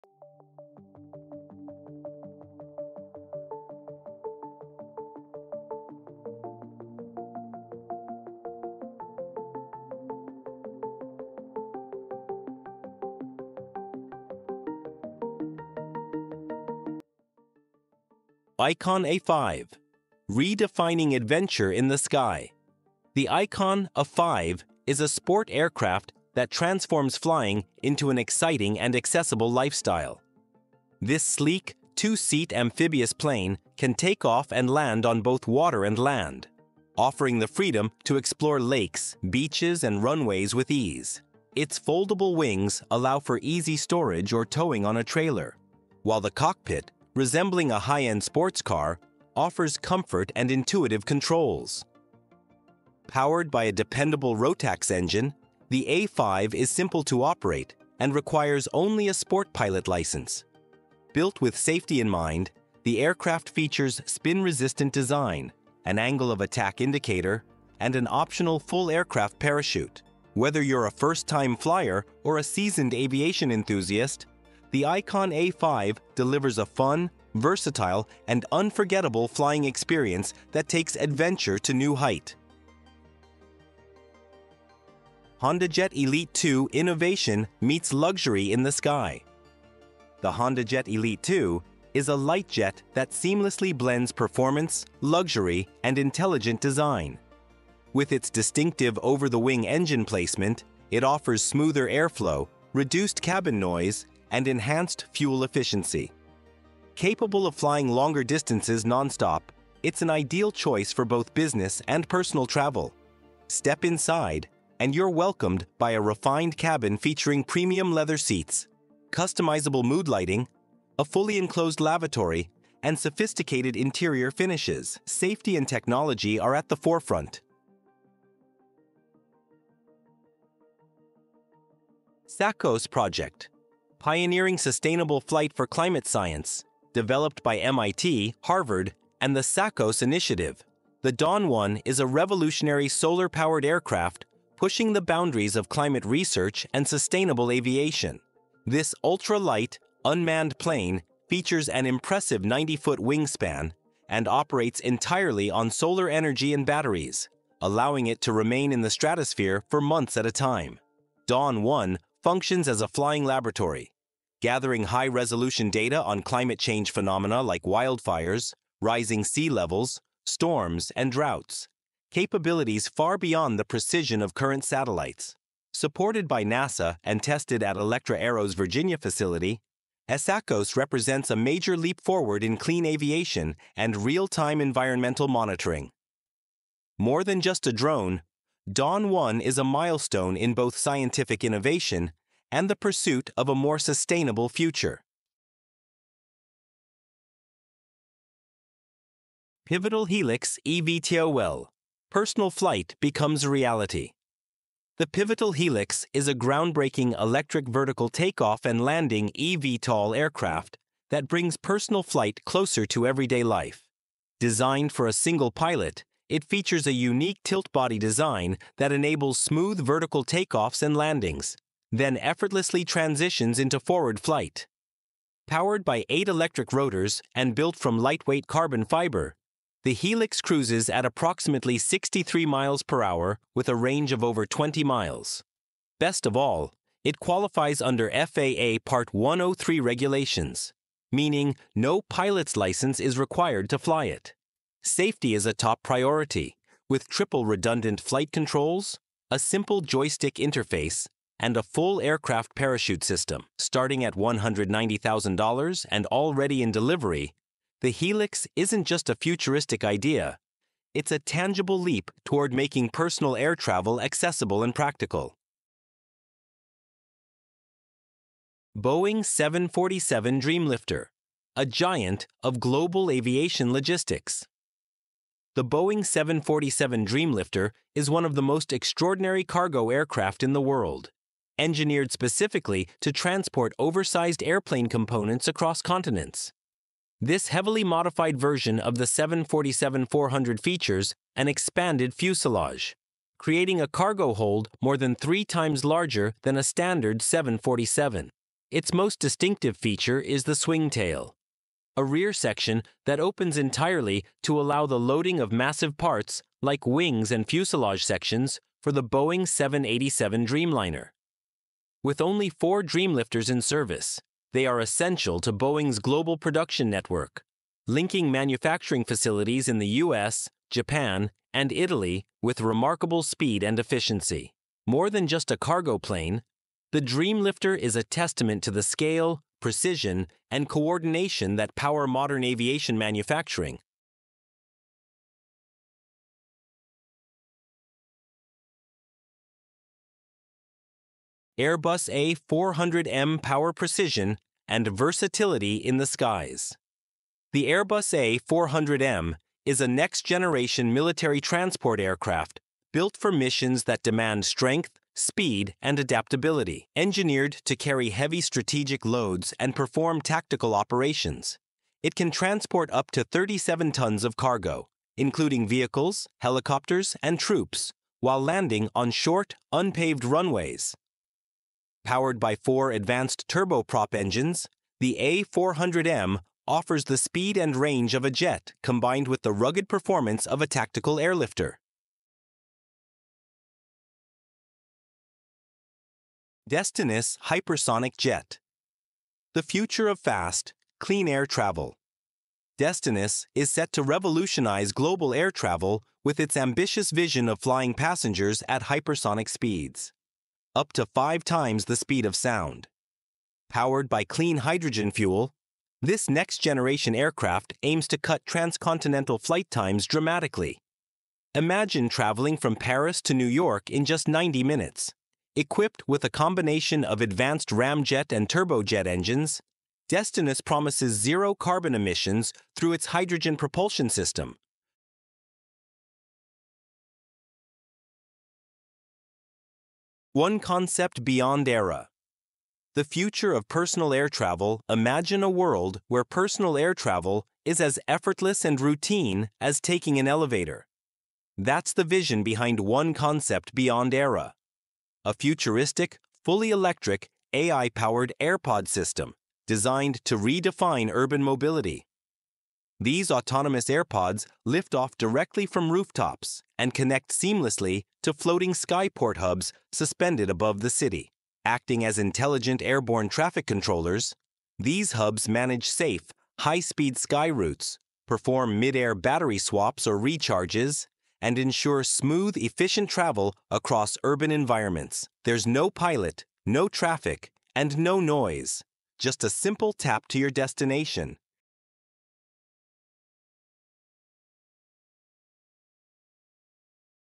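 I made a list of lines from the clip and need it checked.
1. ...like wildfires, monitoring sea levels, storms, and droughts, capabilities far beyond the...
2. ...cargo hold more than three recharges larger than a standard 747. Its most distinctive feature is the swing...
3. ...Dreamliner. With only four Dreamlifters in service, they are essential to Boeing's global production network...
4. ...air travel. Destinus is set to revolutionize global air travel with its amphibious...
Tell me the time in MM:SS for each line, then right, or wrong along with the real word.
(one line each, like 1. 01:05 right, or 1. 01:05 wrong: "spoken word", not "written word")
1. 02:47 wrong: "rising", not "monitoring"
2. 04:53 wrong: "times", not "recharges"
3. 05:10 right
4. 06:31 wrong: "ambitious", not "amphibious".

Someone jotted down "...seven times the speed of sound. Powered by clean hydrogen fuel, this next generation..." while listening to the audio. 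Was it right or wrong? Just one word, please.
wrong.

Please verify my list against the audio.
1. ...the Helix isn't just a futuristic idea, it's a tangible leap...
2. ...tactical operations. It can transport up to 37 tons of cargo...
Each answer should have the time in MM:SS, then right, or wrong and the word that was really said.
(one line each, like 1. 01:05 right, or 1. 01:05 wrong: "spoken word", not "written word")
1. 04:17 right
2. 06:00 right.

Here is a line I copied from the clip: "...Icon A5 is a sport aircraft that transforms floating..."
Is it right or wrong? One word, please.
wrong.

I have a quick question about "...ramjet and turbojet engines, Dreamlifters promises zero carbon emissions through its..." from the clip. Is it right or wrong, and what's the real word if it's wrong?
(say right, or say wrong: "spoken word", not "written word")
wrong: "Destinus", not "Dreamlifters".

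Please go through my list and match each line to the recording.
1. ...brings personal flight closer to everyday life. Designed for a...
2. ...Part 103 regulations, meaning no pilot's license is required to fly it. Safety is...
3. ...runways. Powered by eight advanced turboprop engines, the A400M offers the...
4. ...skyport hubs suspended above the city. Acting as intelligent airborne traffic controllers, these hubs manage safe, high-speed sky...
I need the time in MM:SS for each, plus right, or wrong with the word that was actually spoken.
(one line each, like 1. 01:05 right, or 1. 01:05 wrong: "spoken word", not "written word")
1. 03:31 right
2. 03:58 right
3. 06:10 wrong: "four", not "eight"
4. 07:38 right.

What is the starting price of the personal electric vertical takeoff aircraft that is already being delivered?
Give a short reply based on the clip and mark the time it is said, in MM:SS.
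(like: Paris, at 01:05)
$190,000, at 04:14.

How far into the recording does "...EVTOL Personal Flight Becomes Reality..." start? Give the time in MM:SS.
03:20.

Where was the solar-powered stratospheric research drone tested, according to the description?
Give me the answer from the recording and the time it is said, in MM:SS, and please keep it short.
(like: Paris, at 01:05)
Virginia, at 02:58.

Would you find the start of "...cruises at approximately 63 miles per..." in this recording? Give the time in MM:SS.
03:50.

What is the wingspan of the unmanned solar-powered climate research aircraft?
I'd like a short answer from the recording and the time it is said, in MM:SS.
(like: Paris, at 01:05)
90 feet, at 02:32.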